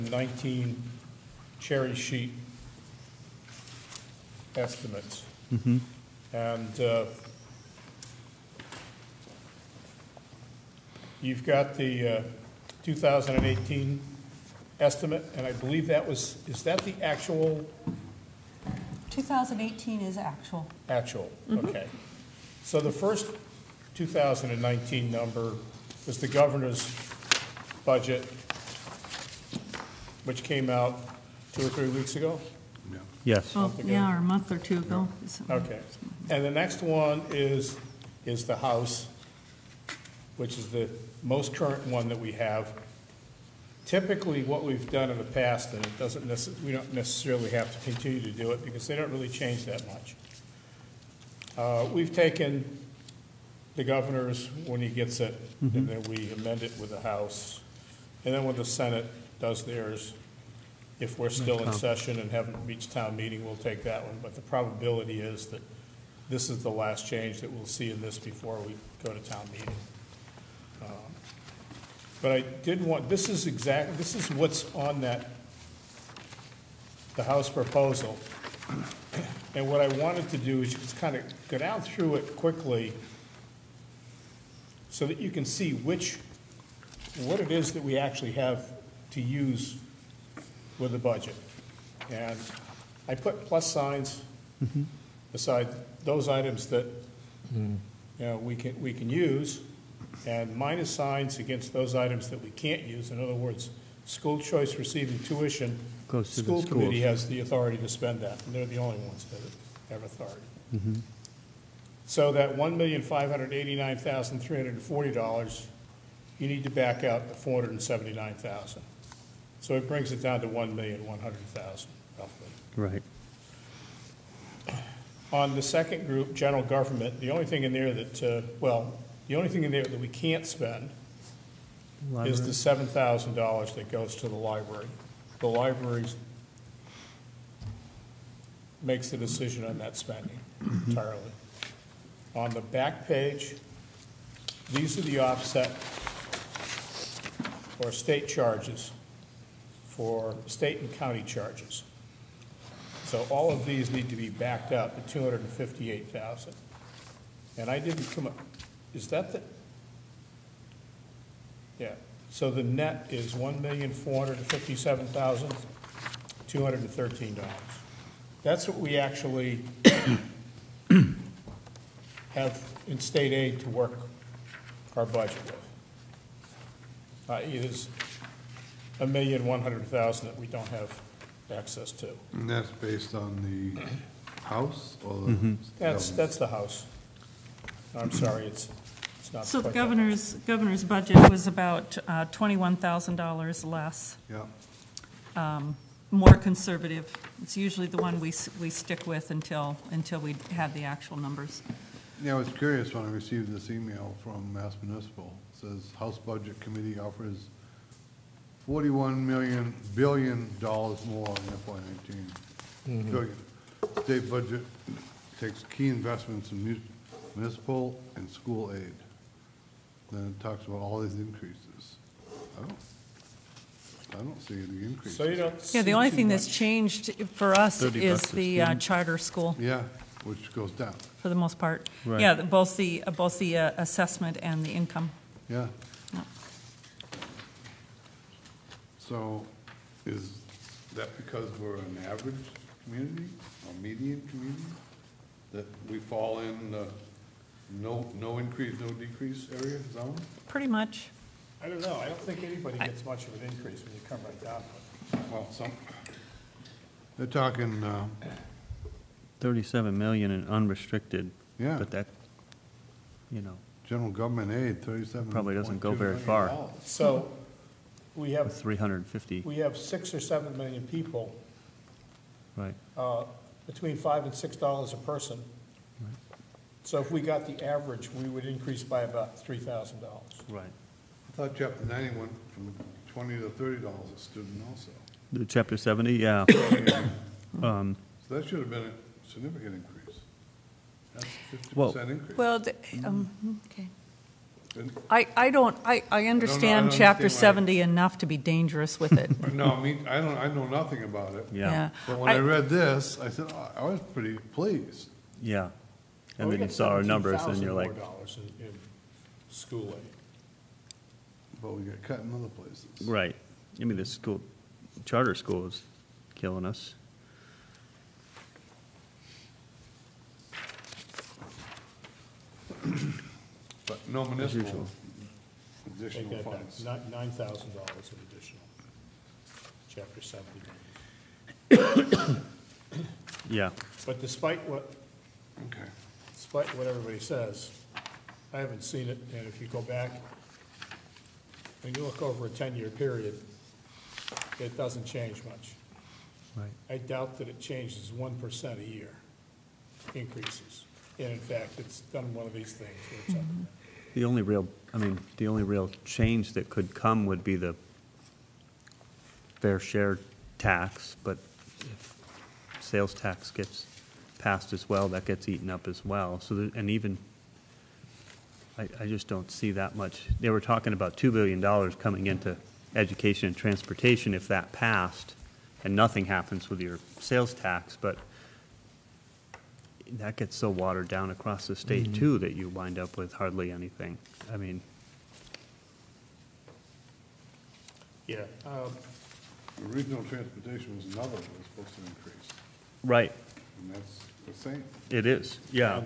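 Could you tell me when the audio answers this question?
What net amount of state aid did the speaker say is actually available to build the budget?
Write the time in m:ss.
2:43.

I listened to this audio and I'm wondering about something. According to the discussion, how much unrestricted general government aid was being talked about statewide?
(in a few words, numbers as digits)
37 million.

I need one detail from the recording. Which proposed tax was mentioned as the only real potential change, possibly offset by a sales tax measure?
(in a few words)
fair share tax.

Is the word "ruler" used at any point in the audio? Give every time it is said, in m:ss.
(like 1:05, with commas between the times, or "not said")
not said.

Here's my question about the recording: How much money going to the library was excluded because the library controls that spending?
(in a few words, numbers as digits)
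$7,000.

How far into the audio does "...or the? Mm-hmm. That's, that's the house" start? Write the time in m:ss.
3:05.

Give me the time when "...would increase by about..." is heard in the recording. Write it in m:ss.
4:38.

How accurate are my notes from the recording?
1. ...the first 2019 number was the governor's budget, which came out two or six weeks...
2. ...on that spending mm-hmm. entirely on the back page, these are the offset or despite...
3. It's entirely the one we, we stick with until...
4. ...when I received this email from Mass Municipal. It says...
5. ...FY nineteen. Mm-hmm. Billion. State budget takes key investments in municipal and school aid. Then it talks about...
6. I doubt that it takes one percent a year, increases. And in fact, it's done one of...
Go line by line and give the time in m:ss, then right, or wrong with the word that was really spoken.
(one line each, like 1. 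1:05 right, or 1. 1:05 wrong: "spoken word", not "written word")
1. 0:22 wrong: "three", not "six"
2. 2:19 wrong: "state", not "despite"
3. 3:17 wrong: "usually", not "entirely"
4. 3:22 right
5. 3:31 right
6. 5:46 wrong: "changes", not "takes".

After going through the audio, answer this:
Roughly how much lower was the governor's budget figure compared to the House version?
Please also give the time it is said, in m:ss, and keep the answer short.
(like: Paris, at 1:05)
$21,000, at 3:12.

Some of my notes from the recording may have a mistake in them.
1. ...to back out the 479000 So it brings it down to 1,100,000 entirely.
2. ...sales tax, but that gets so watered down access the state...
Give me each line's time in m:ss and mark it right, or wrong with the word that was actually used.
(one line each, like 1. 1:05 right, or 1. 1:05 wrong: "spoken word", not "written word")
1. 1:56 wrong: "roughly", not "entirely"
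2. 6:17 wrong: "across", not "access".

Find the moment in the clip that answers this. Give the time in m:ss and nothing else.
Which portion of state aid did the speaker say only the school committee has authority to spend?
1:44.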